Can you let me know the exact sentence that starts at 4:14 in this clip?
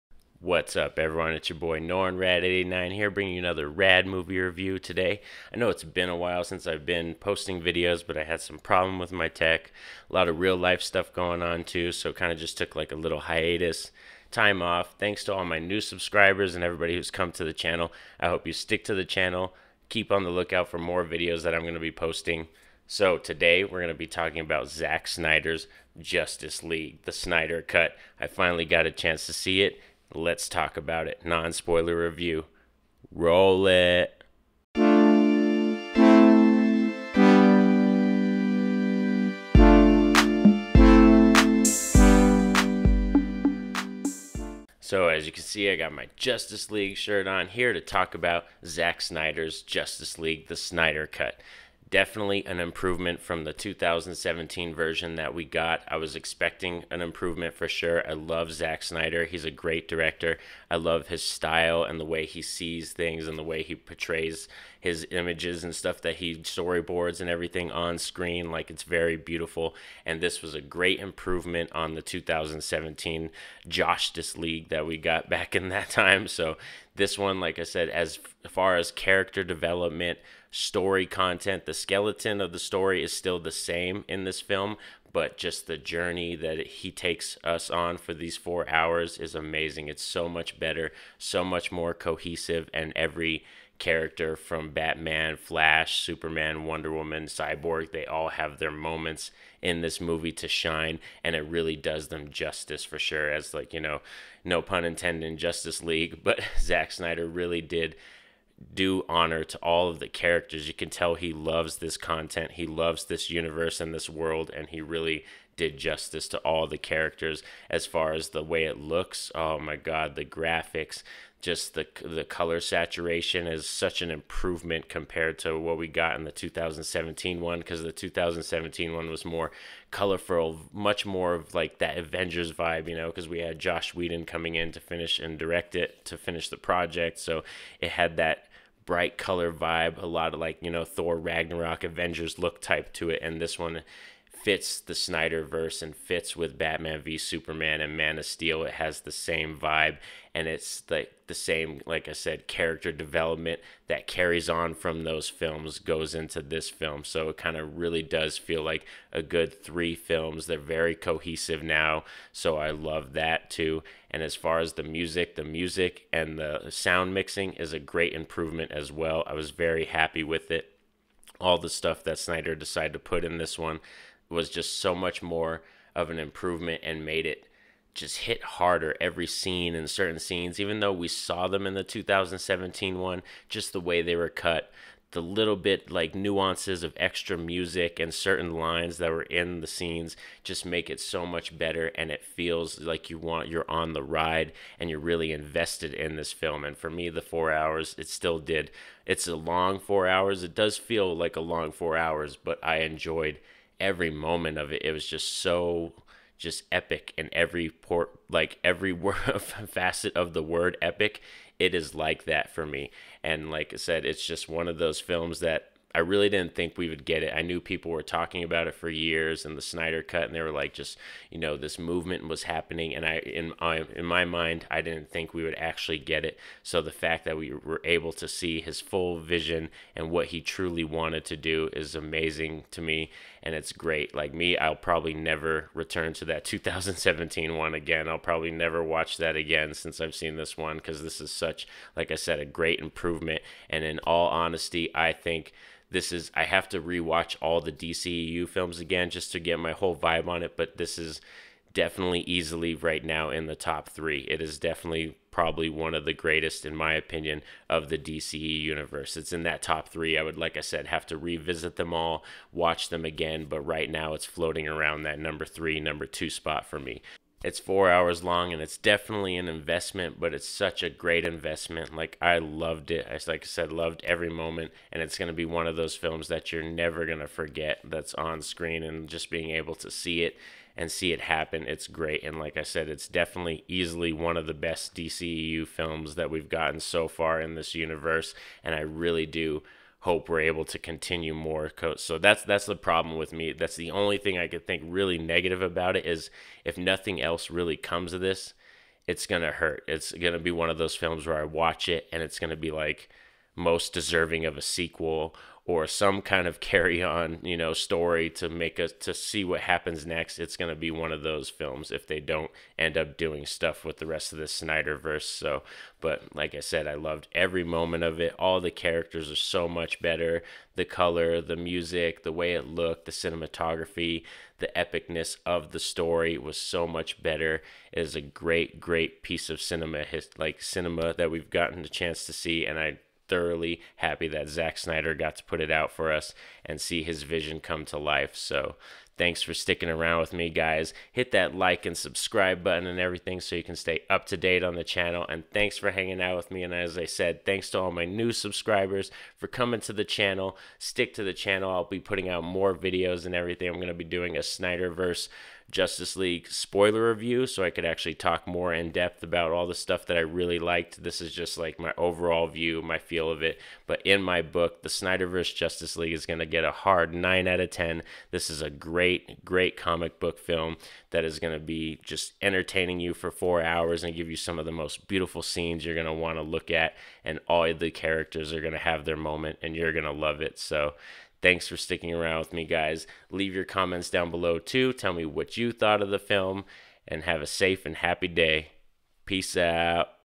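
It is definitely probably one of the greatest in my opinion of the DCE universe.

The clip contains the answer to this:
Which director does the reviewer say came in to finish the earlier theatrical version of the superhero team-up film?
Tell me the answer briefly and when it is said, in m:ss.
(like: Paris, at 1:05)
Josh Whedon, at 2:13.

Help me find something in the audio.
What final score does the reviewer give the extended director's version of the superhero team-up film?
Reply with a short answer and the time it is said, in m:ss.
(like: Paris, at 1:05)
9 out of 10, at 6:07.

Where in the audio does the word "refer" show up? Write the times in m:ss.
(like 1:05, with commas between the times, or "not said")
not said.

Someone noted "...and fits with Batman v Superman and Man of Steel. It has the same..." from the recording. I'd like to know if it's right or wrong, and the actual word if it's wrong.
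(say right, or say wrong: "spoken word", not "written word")
right.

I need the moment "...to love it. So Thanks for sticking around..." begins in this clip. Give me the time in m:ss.
6:20.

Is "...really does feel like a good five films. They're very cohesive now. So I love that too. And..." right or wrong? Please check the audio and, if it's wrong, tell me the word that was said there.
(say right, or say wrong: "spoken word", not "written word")
wrong: "three", not "five".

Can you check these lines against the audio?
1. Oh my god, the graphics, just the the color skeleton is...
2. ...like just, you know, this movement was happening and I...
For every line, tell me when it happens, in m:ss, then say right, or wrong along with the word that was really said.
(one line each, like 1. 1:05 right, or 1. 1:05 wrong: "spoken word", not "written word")
1. 1:59 wrong: "saturation", not "skeleton"
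2. 3:40 right.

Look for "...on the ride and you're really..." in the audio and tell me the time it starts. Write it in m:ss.
3:13.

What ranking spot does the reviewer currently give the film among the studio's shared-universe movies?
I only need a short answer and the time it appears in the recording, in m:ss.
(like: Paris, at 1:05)
Number 3, number 2, at 4:25.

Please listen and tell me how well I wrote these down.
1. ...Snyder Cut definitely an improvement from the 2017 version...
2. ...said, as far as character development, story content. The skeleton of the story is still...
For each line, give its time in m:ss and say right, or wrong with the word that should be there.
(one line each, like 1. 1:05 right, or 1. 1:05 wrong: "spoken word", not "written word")
1. 0:50 right
2. 1:17 right.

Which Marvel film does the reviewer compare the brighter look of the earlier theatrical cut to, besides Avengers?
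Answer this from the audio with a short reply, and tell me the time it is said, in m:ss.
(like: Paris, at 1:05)
Thor: Ragnarok, at 2:20.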